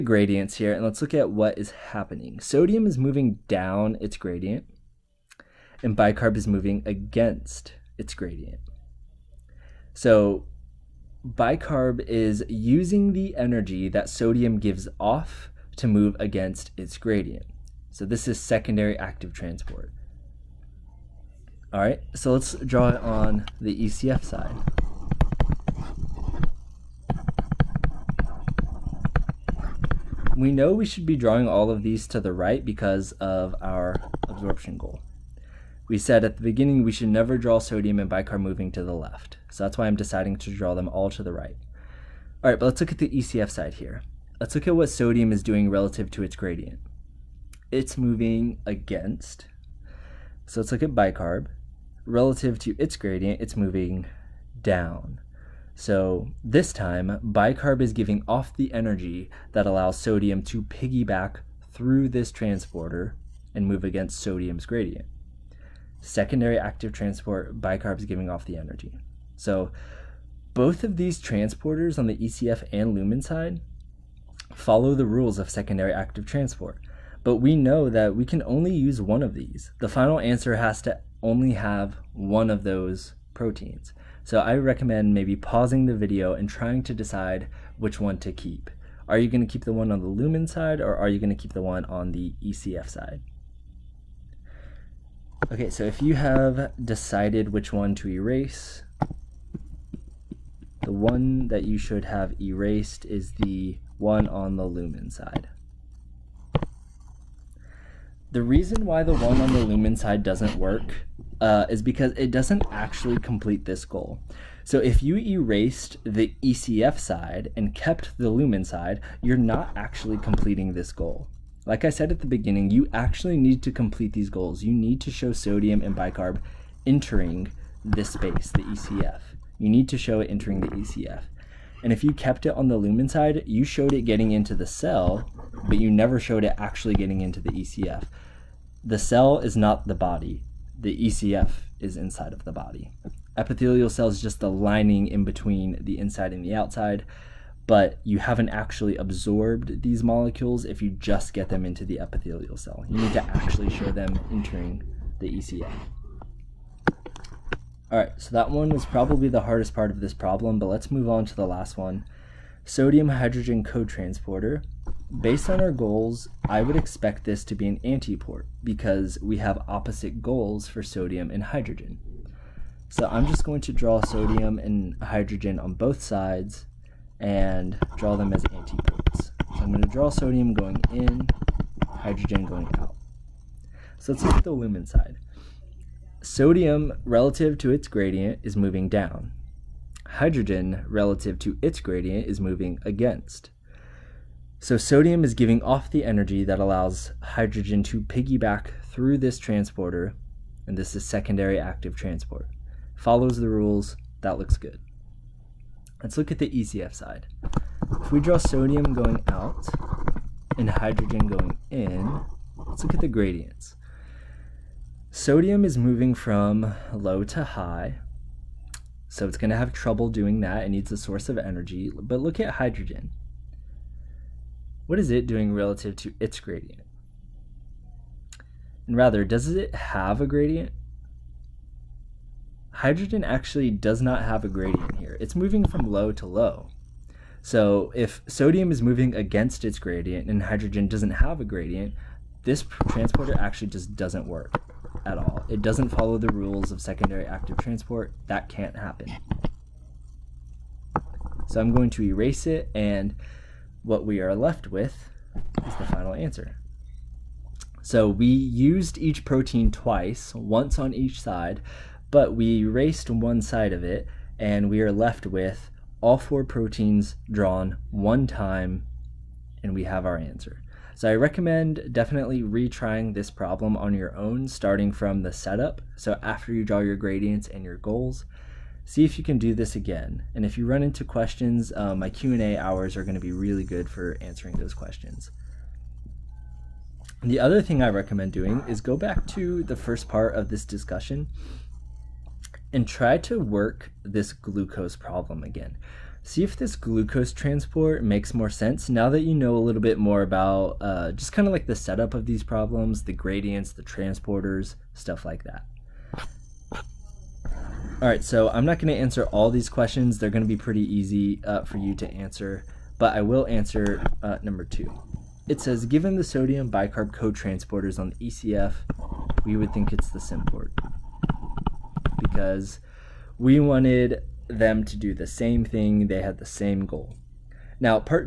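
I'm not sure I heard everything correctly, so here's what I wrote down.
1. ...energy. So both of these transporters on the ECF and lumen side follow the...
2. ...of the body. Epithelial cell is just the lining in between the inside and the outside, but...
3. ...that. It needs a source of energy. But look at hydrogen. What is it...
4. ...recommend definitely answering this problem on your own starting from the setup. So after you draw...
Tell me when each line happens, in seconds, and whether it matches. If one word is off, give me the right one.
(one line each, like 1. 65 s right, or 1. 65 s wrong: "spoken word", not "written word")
1. 68 s right
2. 142 s right
3. 220 s right
4. 271 s wrong: "retrying", not "answering".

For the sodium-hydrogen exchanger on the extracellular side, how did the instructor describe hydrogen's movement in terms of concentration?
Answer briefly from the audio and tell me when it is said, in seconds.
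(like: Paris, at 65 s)
Low to low, at 235 s.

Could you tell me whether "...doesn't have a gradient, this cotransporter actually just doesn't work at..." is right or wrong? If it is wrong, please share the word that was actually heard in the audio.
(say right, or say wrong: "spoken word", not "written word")
wrong: "transporter", not "cotransporter".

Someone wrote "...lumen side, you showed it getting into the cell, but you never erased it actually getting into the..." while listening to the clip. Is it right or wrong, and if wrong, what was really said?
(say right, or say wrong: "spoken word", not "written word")
wrong: "showed", not "erased".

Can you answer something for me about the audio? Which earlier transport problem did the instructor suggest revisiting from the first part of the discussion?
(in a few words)
Glucose problem.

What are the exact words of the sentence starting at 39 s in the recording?
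So that's why I'm deciding to draw them all to the right.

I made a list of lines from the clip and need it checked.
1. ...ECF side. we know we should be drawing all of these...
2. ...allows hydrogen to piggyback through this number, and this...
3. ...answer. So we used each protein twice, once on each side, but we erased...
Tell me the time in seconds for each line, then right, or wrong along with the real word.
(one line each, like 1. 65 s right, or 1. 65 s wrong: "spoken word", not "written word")
1. 23 s right
2. 196 s wrong: "transporter", not "number"
3. 256 s right.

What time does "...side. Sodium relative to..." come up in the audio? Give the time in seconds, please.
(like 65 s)
184 s.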